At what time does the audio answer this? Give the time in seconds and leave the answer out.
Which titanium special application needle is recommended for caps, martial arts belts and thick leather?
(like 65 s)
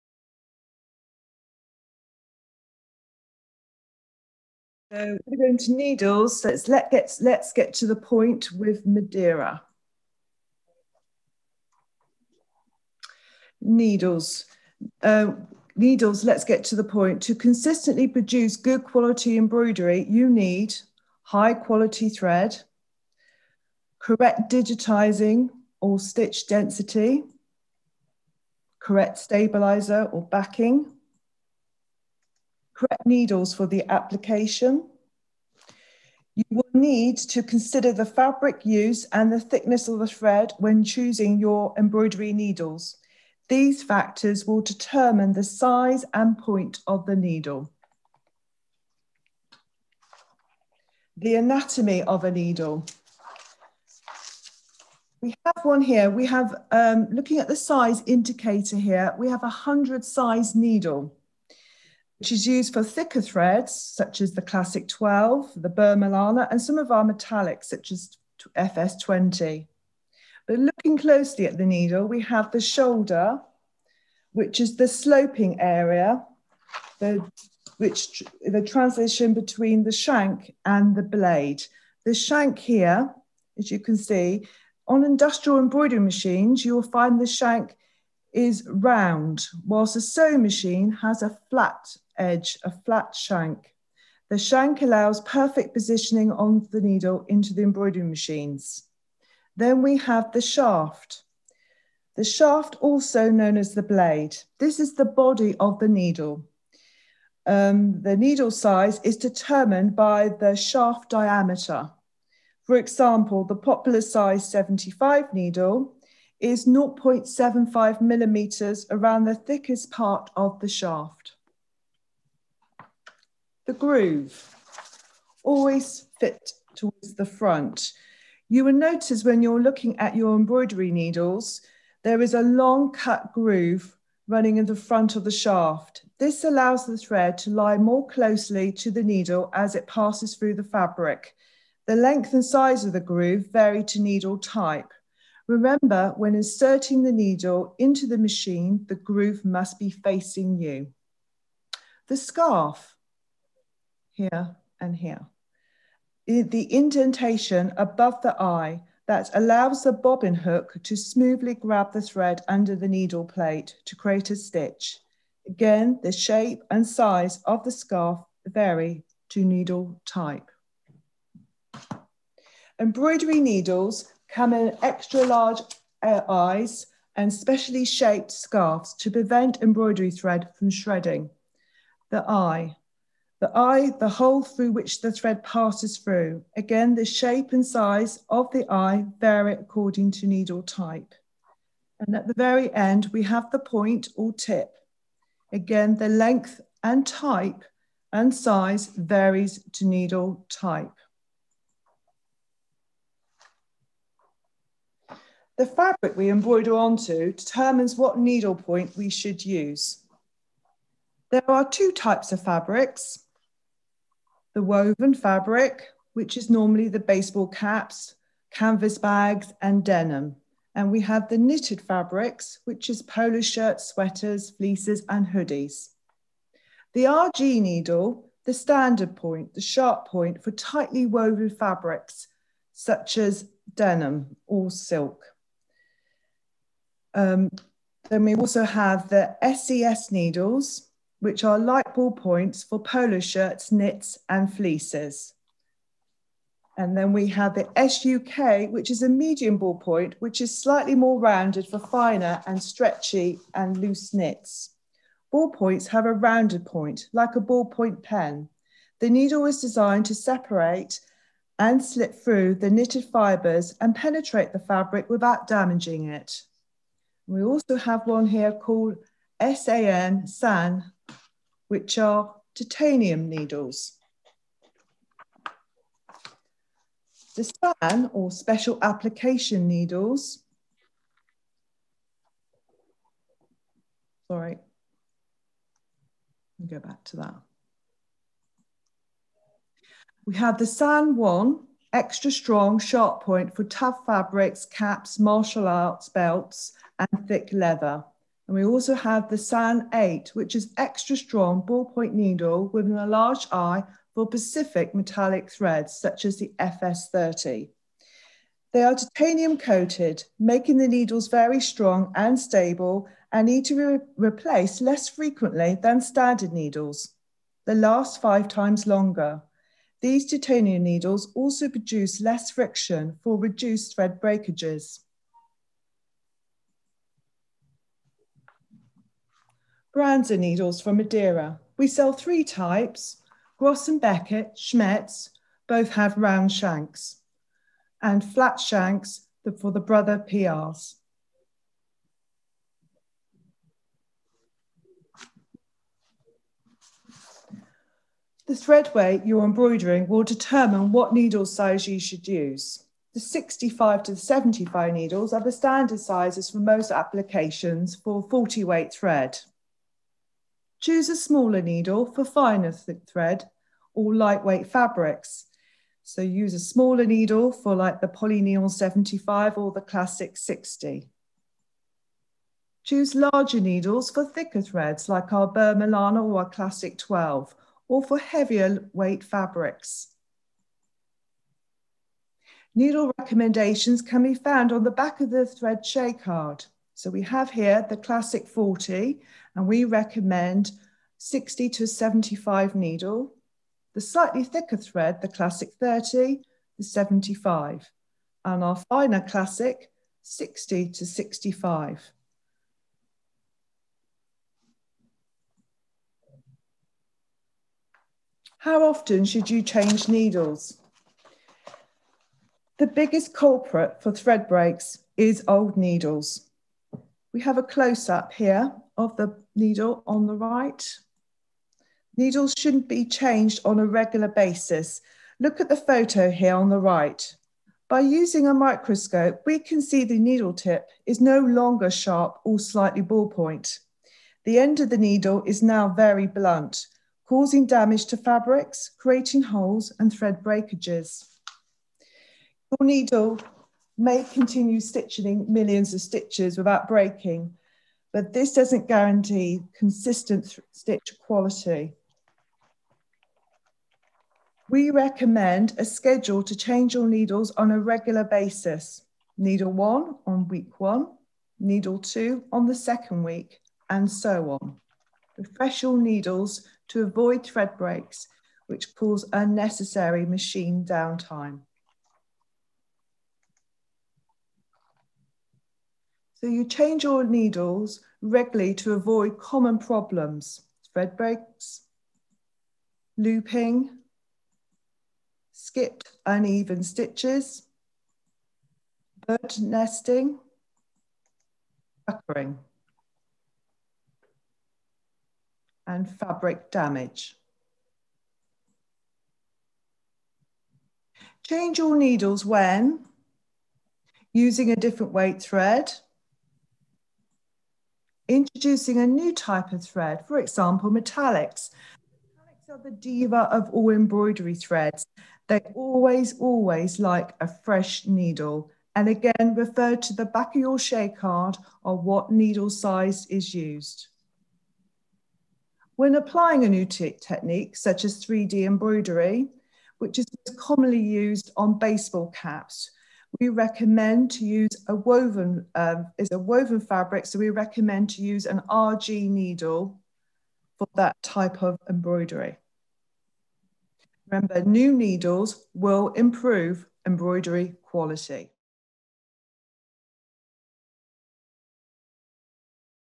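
290 s.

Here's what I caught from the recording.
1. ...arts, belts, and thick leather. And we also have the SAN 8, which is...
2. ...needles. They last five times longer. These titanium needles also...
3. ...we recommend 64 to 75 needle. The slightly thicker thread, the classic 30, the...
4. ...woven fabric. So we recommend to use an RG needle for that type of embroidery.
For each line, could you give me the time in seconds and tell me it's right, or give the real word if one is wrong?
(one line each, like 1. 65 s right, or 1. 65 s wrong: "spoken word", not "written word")
1. 295 s right
2. 316 s right
3. 389 s wrong: "60", not "64"
4. 536 s right.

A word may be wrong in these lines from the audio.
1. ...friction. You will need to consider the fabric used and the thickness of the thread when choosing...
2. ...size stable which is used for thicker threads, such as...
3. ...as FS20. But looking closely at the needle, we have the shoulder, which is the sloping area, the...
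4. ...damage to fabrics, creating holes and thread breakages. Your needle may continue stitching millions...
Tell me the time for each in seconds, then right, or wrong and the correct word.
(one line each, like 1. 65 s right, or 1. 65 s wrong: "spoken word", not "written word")
1. 33 s wrong: "application", not "friction"
2. 60 s wrong: "needle", not "stable"
3. 67 s right
4. 437 s right.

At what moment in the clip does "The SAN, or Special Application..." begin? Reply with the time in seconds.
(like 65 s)
277 s.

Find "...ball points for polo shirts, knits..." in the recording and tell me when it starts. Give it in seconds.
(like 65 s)
241 s.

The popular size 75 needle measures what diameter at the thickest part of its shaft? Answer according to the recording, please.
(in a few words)
0.75 millimeters.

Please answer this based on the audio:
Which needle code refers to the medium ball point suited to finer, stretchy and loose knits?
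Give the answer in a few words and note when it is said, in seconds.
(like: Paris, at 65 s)
SUK, at 247 s.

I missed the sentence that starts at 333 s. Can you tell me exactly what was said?
Groz and Beckert, Schmetz, both have round shanks.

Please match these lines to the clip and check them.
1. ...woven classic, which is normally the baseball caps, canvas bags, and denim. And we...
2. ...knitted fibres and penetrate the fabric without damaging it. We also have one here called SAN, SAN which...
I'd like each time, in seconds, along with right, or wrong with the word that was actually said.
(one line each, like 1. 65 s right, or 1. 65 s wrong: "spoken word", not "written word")
1. 214 s wrong: "fabric", not "classic"
2. 262 s right.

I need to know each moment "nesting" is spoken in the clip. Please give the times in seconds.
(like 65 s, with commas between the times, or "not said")
489 s.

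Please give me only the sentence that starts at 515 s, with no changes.
They always, always like a fresh needle.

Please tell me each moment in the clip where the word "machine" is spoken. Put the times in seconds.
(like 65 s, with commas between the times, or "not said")
85 s, 90 s, 98 s, 148 s, 470 s.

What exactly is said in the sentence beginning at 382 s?
Needle recommendations can be found on the back of the thread shade card.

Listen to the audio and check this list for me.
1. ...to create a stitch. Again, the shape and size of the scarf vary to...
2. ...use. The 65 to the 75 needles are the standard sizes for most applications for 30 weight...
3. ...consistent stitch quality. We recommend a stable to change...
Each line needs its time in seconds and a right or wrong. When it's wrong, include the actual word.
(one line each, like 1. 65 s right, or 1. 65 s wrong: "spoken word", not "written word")
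1. 163 s right
2. 352 s wrong: "40", not "30"
3. 449 s wrong: "schedule", not "stable".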